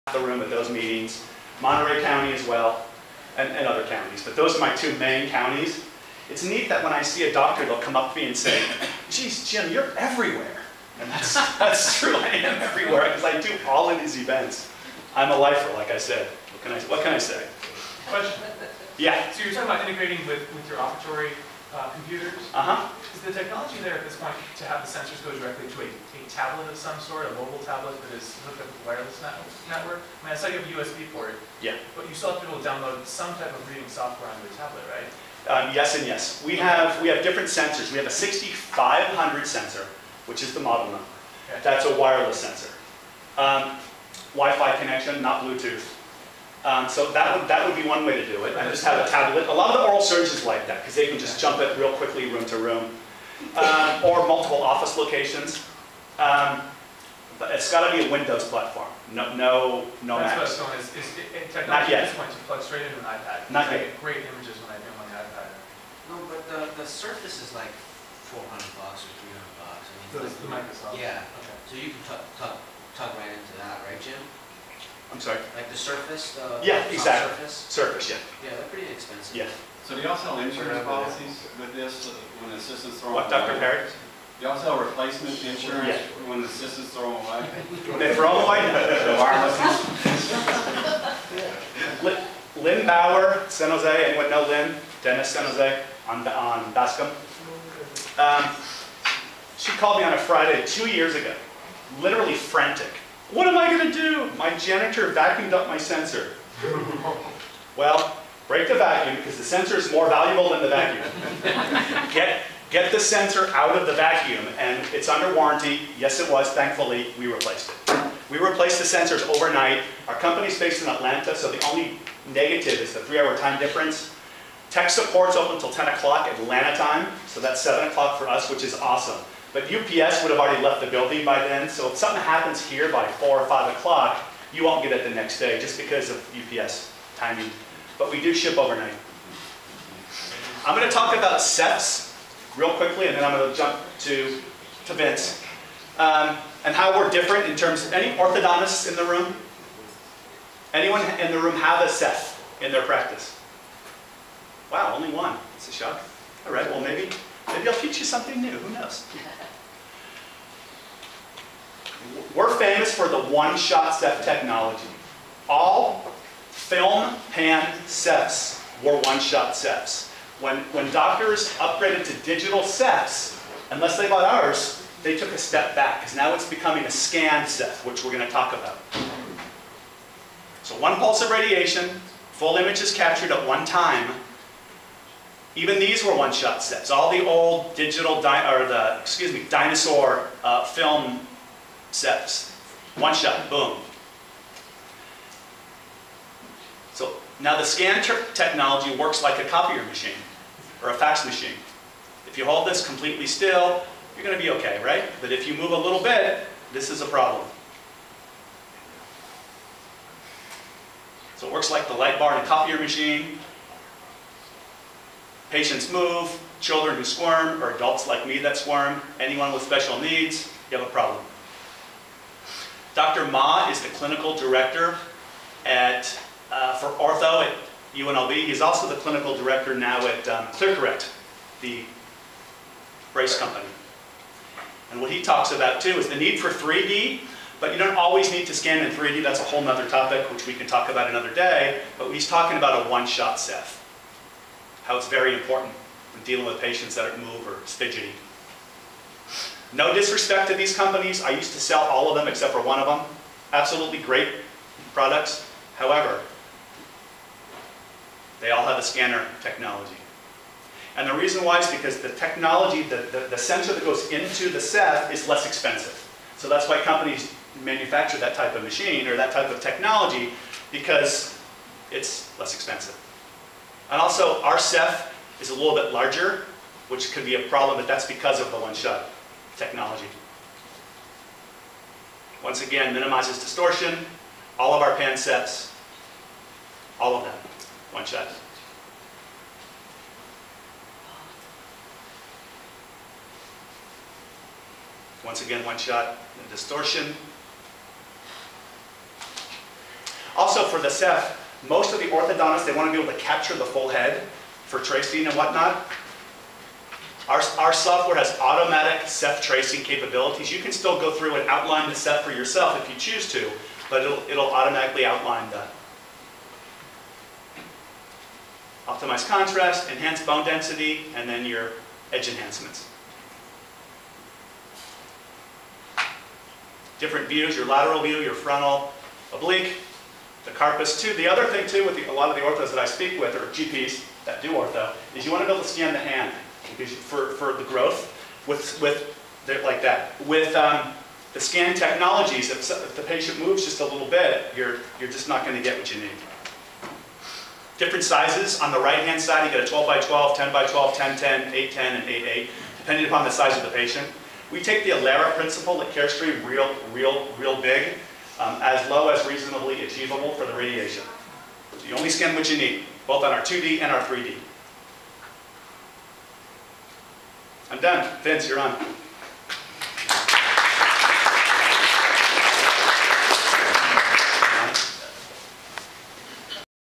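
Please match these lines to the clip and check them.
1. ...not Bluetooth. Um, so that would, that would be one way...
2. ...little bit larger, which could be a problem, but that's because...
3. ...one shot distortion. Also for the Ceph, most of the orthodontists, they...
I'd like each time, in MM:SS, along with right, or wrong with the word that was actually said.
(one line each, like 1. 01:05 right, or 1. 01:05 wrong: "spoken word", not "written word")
1. 00:45 right
2. 04:35 right
3. 04:55 right.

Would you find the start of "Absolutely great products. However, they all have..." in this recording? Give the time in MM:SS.
04:13.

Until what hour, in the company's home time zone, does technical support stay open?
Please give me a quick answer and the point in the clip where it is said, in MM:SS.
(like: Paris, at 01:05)
10 o'clock, at 02:05.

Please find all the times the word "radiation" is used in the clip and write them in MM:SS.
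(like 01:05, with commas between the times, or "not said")
03:01, 06:00.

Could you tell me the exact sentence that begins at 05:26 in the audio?
Different views, your lateral view, your frontal, oblique, the carpus too.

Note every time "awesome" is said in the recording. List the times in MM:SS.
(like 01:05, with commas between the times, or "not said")
02:08.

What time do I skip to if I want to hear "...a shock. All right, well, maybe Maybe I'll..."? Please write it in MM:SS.
02:35.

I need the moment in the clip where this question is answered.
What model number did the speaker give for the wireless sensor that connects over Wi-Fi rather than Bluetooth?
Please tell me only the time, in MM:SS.
00:38.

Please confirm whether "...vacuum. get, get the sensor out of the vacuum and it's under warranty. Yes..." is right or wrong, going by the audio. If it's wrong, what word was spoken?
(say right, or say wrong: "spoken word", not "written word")
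right.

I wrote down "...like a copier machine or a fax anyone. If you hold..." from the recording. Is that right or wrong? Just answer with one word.
wrong.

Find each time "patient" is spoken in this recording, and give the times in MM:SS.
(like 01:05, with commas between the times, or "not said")
03:35, 04:06, 05:43, 05:53.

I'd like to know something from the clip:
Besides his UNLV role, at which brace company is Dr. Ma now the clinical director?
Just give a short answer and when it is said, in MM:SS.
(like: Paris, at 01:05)
ClearCorrect, at 03:50.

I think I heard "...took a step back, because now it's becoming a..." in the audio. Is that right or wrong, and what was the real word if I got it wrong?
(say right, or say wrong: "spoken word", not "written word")
right.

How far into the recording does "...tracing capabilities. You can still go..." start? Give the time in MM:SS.
05:09.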